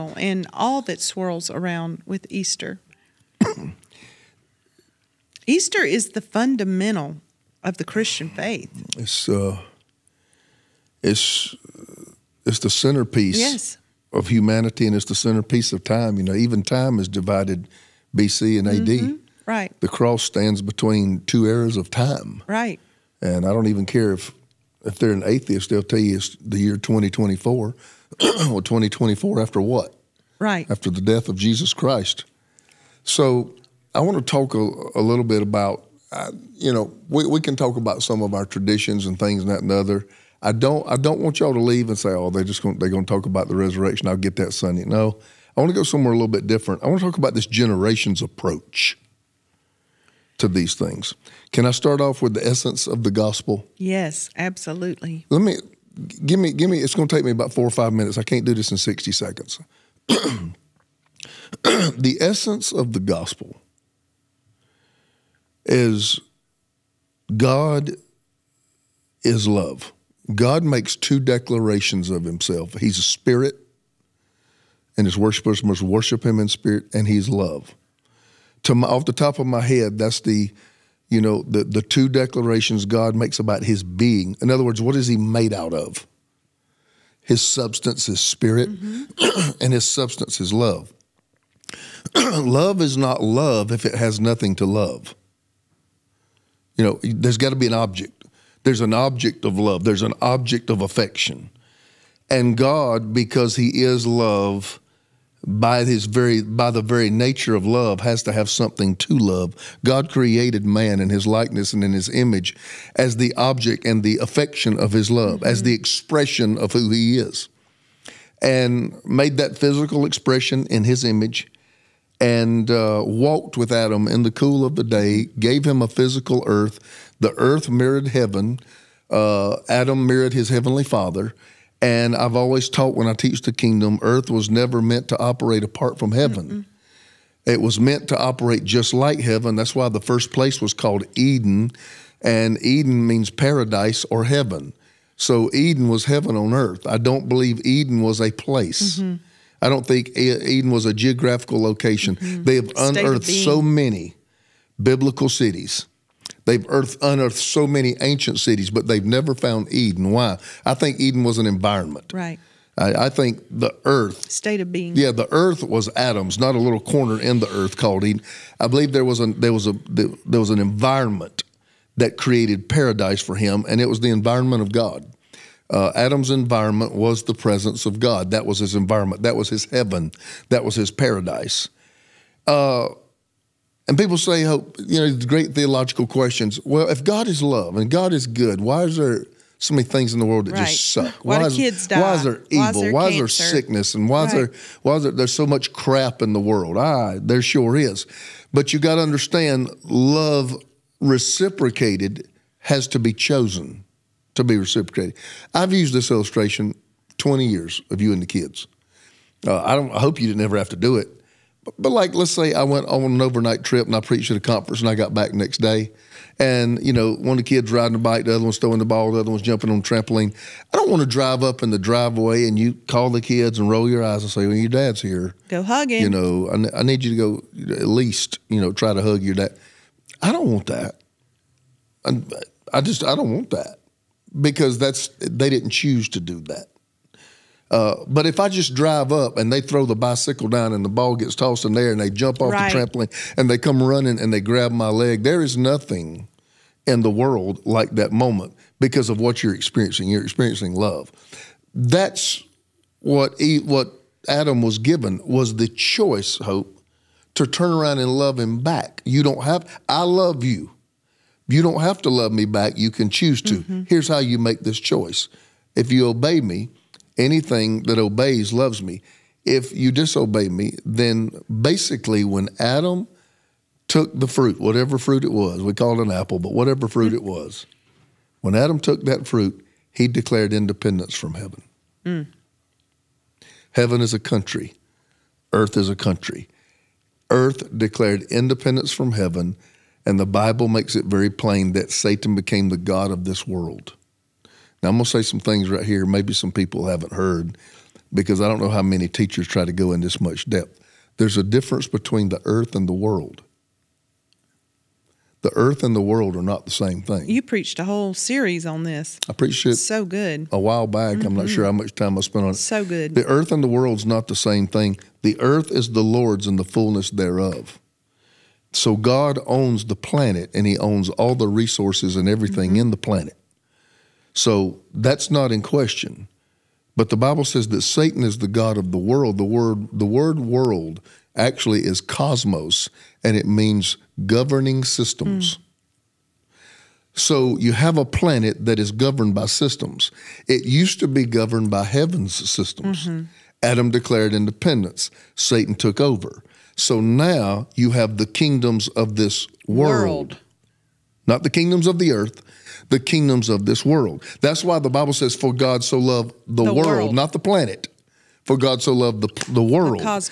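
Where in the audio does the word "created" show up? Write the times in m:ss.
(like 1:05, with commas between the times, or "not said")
1:50, 2:52.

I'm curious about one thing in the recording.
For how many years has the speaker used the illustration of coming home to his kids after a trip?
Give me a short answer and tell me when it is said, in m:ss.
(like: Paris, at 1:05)
20, at 3:27.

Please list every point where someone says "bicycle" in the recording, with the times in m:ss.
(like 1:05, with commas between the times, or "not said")
3:59.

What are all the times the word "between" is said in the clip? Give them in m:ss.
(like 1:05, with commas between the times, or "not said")
0:20, 5:01.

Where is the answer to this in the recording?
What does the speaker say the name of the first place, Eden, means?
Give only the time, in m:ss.
2:23.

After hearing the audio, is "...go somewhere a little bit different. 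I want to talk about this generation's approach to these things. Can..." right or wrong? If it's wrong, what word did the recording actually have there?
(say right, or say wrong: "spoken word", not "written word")
right.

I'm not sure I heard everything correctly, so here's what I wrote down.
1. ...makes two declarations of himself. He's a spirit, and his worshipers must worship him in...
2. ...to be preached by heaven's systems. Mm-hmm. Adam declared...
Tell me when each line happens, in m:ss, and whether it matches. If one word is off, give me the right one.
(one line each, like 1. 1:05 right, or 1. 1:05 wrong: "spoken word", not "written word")
1. 1:10 right
2. 5:40 wrong: "governed", not "preached".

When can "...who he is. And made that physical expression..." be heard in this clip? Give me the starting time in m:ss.
1:56.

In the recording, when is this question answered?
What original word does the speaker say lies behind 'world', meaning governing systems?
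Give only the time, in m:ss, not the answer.
5:31.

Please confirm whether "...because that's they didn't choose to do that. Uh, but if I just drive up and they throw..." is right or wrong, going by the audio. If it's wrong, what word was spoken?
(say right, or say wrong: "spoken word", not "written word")
right.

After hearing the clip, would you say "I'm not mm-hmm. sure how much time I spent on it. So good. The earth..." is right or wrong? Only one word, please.
right.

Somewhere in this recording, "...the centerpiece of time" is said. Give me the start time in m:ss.
0:15.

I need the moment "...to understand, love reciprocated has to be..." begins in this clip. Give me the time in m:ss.
3:18.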